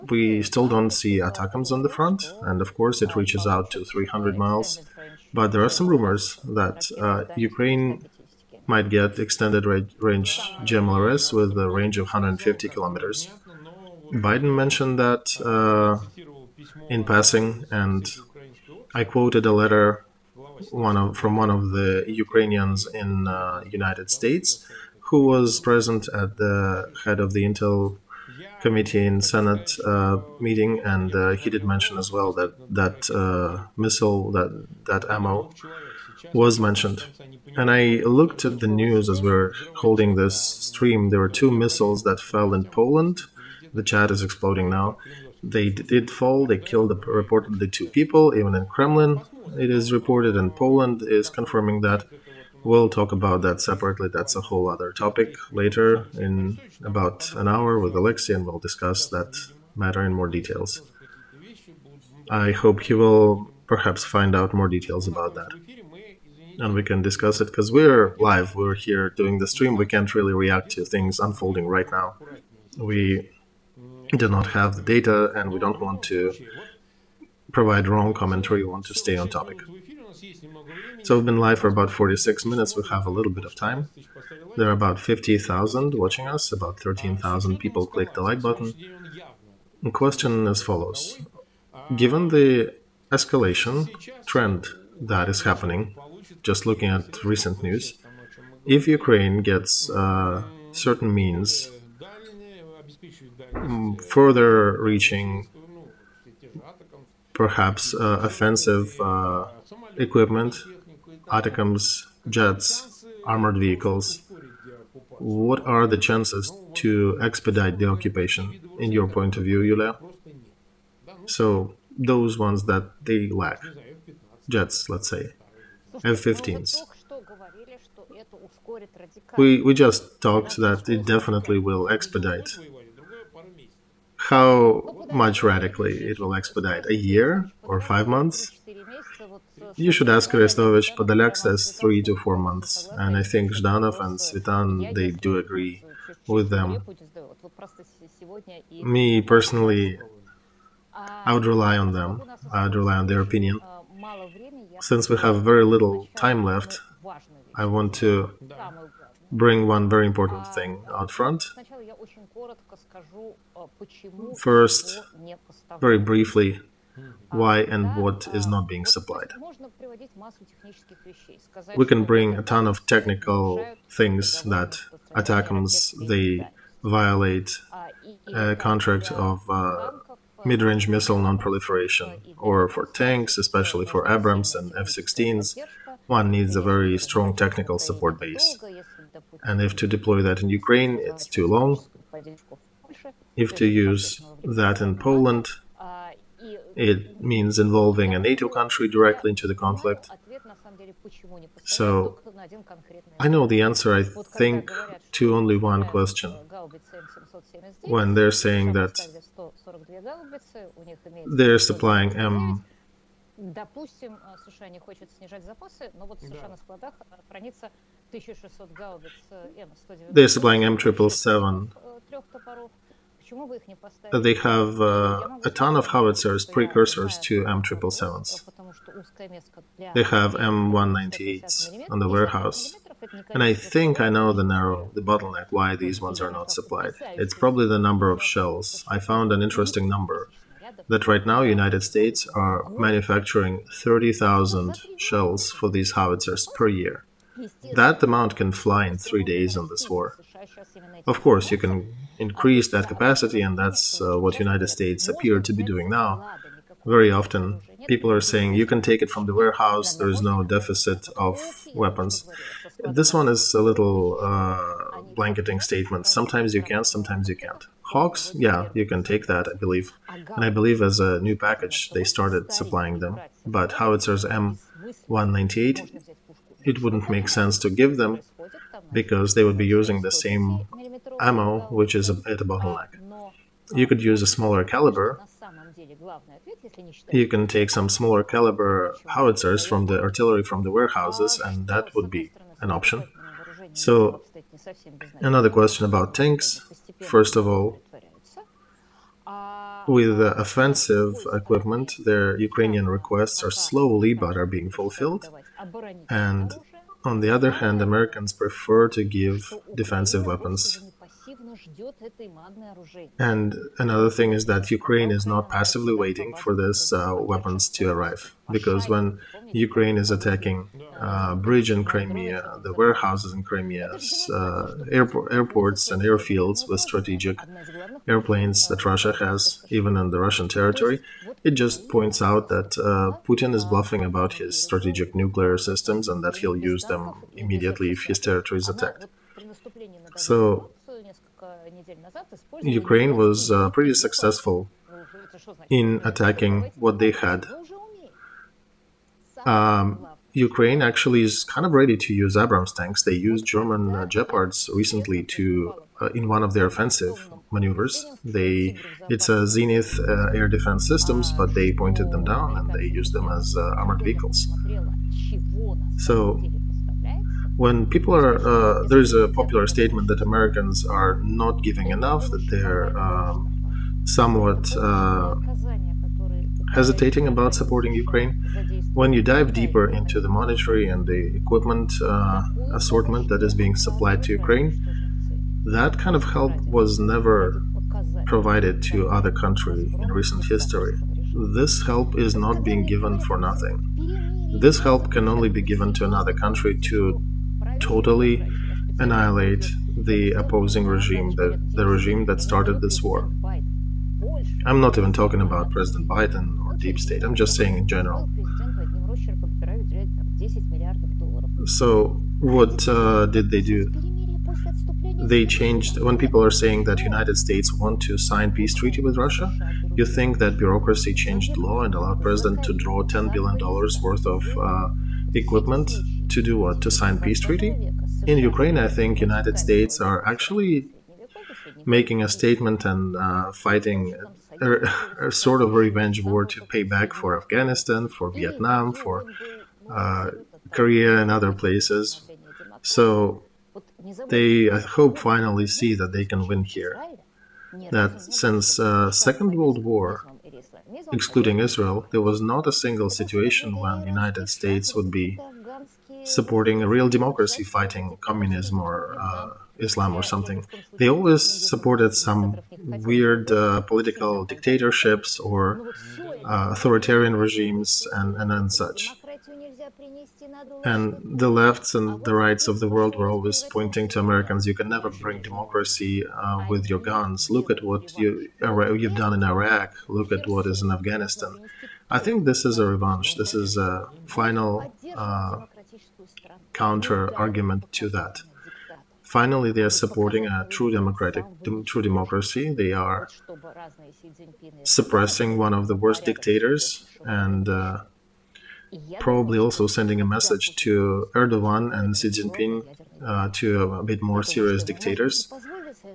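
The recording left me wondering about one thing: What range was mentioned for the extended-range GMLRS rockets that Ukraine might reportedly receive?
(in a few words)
150 kilometers.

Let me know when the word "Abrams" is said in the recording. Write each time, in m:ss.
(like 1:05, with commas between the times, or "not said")
3:04, 5:52.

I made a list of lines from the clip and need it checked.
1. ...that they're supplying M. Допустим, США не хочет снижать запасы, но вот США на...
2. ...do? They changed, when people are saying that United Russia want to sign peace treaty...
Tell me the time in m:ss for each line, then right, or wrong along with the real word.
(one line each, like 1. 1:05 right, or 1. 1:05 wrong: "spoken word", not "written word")
1. 3:28 right
2. 6:53 wrong: "States", not "Russia".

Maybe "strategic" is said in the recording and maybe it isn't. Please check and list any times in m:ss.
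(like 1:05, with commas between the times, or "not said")
5:26, 5:34.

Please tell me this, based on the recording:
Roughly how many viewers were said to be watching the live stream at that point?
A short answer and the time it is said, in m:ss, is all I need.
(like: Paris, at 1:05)
50,000, at 1:24.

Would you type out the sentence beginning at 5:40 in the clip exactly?
So Ukraine was uh, pretty successful in attacking what they had.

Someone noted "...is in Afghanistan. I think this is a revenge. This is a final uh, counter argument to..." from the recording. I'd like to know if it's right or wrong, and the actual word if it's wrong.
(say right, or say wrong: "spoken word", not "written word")
right.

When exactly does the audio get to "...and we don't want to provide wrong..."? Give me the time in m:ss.
1:15.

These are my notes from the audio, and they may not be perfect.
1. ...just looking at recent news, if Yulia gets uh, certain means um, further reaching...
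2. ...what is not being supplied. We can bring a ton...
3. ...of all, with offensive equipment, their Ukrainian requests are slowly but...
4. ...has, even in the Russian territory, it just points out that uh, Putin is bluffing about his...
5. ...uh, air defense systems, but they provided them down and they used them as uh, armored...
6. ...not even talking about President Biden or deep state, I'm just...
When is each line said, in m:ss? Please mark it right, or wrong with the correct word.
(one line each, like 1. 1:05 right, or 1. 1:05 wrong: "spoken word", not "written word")
1. 1:36 wrong: "Ukraine", not "Yulia"
2. 2:47 right
3. 4:57 right
4. 5:29 right
5. 6:00 wrong: "pointed", not "provided"
6. 6:44 right.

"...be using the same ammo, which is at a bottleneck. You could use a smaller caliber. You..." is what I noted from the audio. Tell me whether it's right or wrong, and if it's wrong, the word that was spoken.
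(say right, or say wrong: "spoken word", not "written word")
right.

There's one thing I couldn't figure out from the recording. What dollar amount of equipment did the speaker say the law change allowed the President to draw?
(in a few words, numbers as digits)
$10 billion.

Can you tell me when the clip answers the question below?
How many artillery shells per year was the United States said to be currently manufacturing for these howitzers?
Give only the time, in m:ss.
4:03.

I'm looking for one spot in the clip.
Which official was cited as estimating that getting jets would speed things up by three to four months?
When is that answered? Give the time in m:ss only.
2:20.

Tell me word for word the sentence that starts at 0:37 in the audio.
And I looked at the news as we are holding this stream.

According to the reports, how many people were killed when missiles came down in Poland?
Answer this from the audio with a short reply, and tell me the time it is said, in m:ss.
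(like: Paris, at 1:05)
2, at 0:47.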